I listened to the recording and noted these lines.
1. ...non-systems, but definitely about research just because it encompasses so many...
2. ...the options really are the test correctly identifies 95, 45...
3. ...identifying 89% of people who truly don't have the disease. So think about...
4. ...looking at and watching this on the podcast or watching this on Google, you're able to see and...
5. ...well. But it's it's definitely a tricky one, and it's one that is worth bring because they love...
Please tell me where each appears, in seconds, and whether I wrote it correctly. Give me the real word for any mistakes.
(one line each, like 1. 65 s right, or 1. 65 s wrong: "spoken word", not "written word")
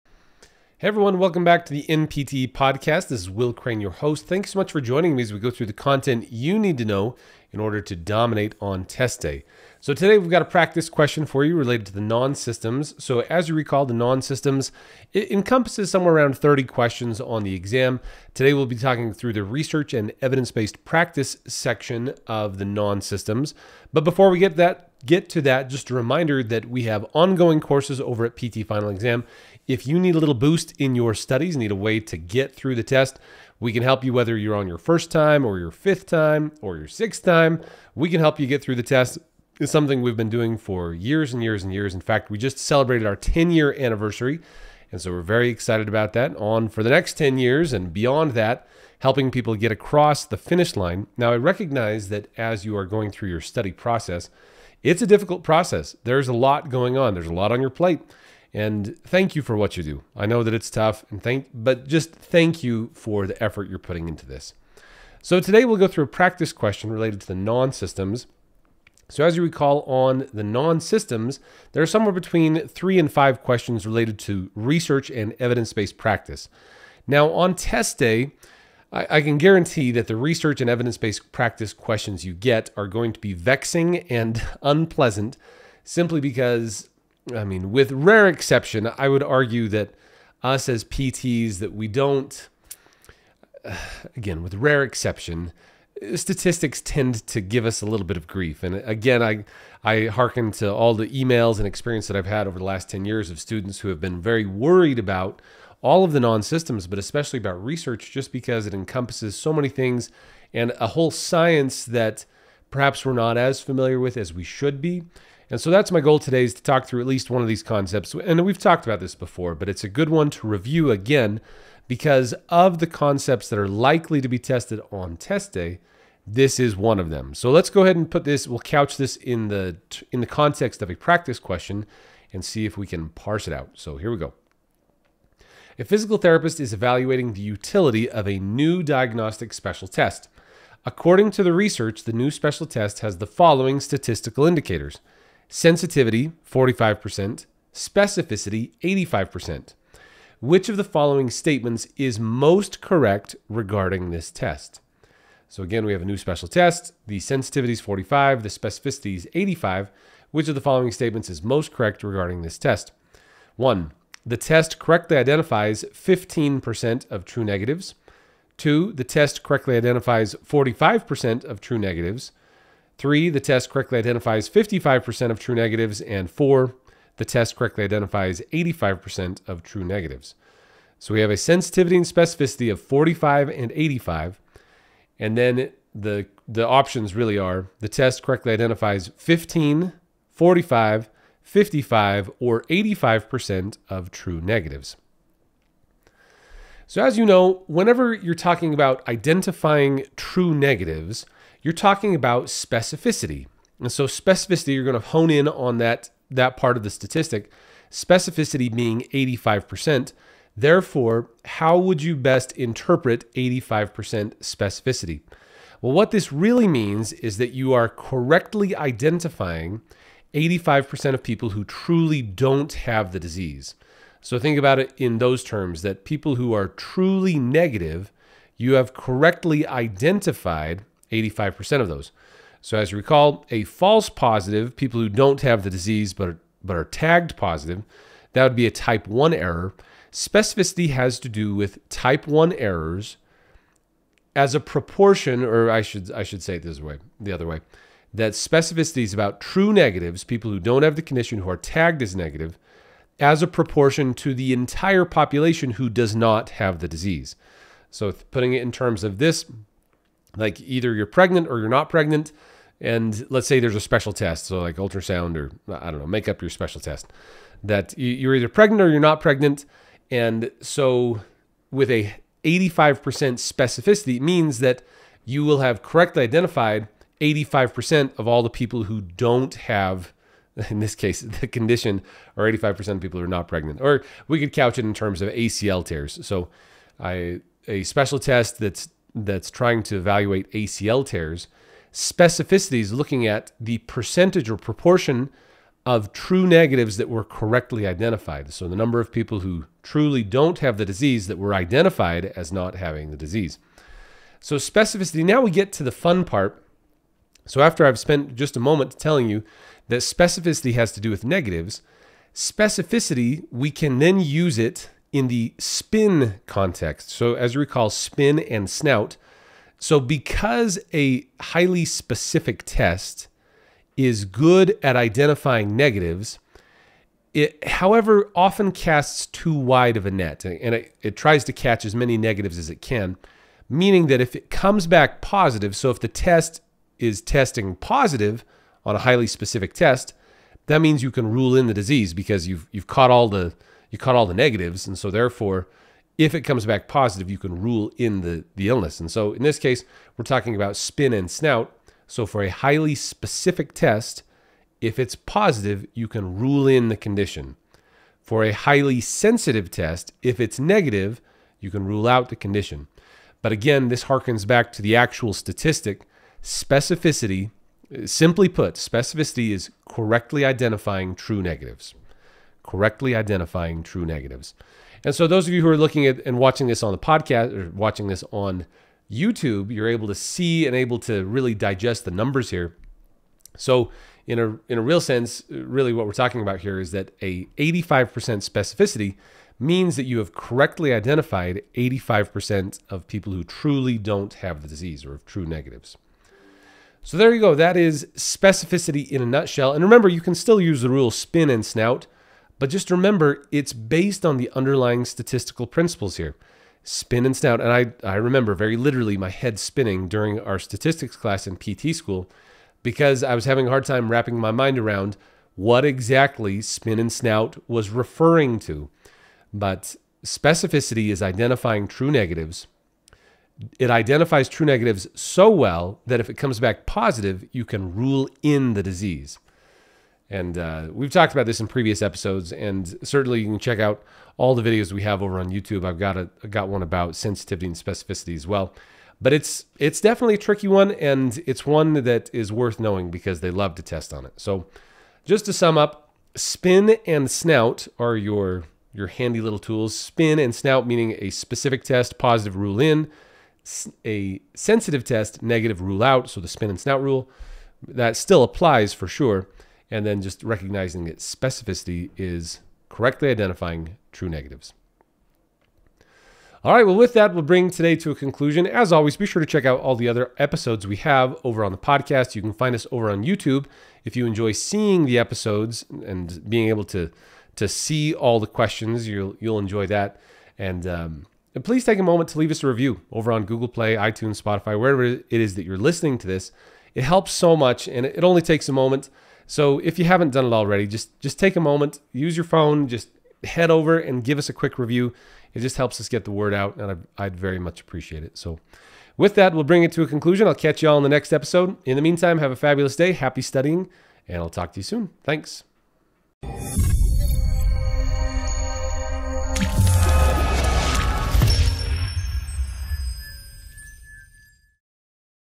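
1. 106 s wrong: "especially", not "definitely"
2. 186 s wrong: "15", not "95"
3. 218 s wrong: "85", not "89"
4. 375 s wrong: "YouTube", not "Google"
5. 438 s wrong: "knowing", not "bring".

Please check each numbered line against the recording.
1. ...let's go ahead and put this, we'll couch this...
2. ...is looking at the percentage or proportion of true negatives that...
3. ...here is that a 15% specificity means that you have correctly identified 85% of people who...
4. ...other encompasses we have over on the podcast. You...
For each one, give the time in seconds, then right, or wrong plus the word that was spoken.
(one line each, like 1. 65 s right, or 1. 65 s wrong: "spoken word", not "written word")
1. 127 s right
2. 292 s right
3. 386 s wrong: "85", not "15"
4. 470 s wrong: "episodes", not "encompasses".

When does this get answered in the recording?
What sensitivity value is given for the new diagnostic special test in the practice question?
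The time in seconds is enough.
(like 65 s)
145 s.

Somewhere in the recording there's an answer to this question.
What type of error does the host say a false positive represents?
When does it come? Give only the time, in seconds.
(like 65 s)
238 s.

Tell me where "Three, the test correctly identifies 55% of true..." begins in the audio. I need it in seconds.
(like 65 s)
173 s.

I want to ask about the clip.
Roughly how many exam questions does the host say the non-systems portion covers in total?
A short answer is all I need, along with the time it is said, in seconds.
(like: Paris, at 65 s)
30, at 16 s.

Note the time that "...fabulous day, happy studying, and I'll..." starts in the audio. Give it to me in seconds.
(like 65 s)
502 s.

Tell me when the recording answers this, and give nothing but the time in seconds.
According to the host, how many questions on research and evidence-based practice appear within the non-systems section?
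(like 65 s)
72 s.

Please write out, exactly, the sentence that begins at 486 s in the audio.
It helps so much, and it only takes a moment.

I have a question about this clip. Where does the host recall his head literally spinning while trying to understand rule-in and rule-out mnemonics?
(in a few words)
statistics class in PT school.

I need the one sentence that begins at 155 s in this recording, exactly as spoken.
So again, we have a new special test.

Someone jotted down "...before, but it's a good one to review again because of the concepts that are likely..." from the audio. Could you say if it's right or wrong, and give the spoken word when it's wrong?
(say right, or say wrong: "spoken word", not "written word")
right.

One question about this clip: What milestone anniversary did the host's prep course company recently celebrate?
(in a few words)
10 year.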